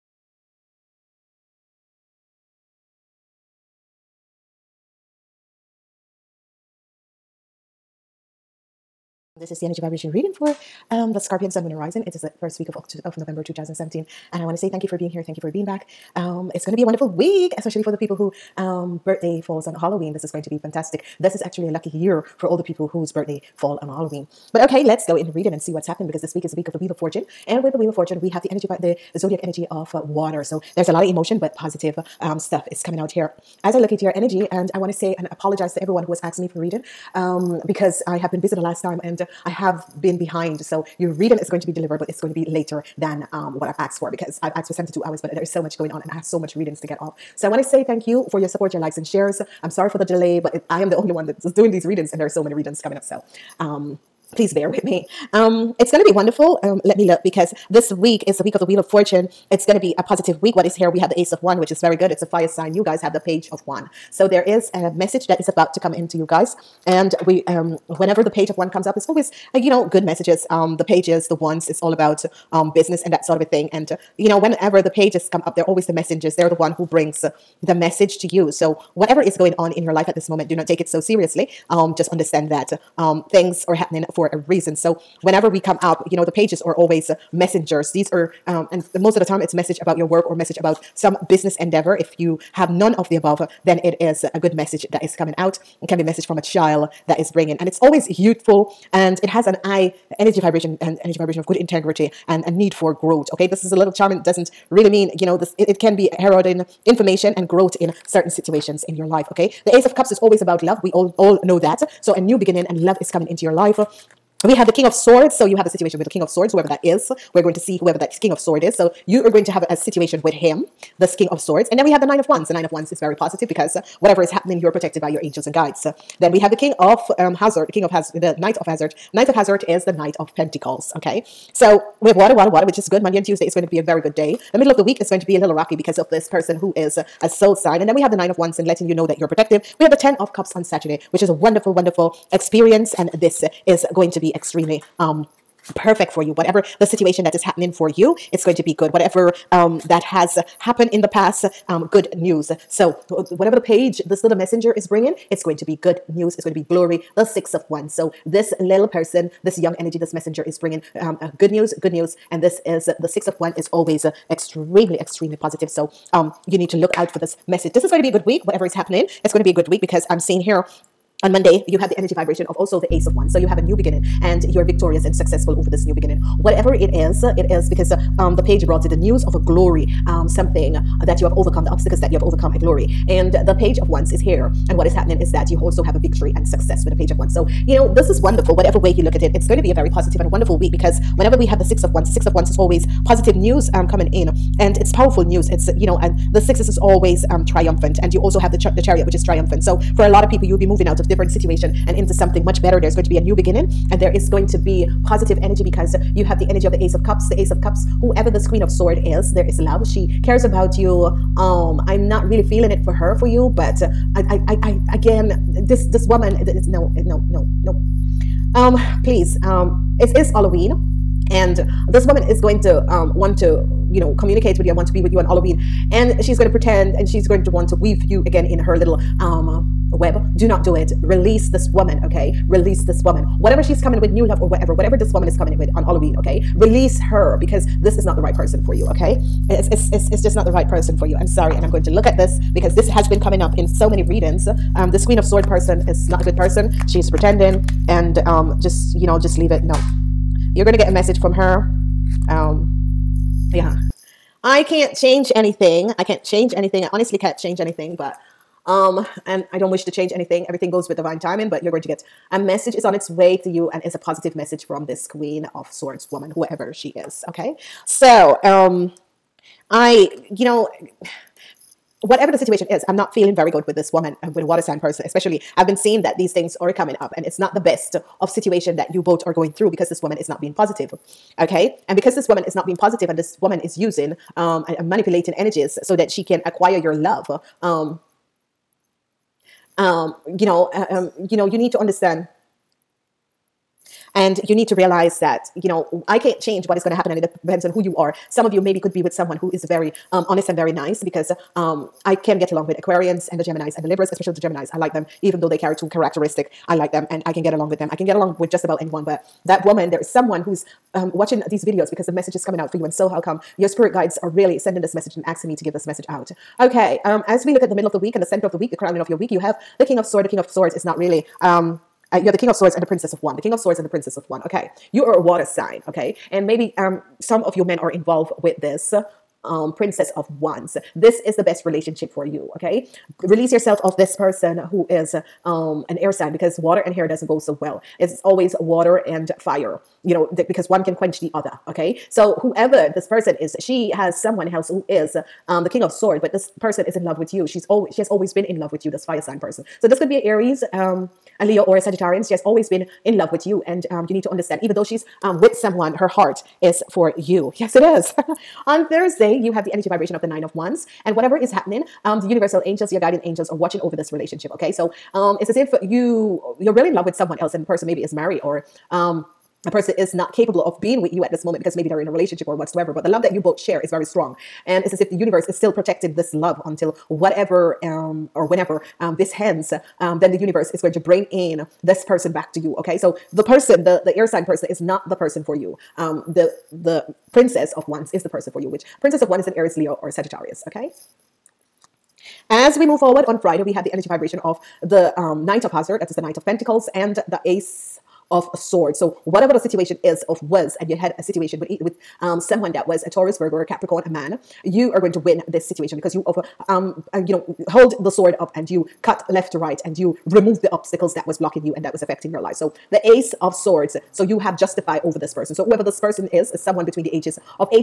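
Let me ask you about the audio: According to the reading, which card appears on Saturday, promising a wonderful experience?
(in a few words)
Ten of Cups.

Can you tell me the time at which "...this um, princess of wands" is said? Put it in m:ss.
5:28.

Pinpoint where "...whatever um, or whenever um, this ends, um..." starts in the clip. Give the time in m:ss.
6:17.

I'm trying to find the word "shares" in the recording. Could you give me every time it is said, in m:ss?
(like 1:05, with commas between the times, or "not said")
0:49, 6:13.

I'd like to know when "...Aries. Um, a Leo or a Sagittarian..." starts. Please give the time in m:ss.
5:50.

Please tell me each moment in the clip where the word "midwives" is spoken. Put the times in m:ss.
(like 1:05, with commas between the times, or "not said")
not said.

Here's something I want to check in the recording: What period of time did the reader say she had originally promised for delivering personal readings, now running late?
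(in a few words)
72 hours.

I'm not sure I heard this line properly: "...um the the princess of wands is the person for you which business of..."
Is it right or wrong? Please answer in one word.
wrong.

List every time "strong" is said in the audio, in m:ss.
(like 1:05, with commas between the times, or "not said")
6:14.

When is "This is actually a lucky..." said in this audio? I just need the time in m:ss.
0:21.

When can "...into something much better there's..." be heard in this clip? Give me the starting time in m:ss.
3:21.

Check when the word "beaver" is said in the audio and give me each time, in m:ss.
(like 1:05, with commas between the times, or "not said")
not said.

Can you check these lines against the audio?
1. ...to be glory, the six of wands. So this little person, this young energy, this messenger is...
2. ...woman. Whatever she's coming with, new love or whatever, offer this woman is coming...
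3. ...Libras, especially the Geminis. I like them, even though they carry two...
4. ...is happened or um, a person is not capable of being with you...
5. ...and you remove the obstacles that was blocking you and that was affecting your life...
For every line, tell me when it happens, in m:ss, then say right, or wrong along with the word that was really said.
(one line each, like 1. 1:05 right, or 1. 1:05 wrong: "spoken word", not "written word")
1. 2:36 right
2. 3:53 wrong: "whatever", not "offer"
3. 5:03 right
4. 6:08 wrong: "married", not "happened"
5. 6:49 right.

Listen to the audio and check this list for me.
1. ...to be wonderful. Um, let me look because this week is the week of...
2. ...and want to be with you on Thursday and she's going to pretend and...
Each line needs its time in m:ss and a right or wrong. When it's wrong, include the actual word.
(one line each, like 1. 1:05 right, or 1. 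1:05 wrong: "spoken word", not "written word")
1. 0:56 right
2. 3:44 wrong: "Halloween", not "Thursday".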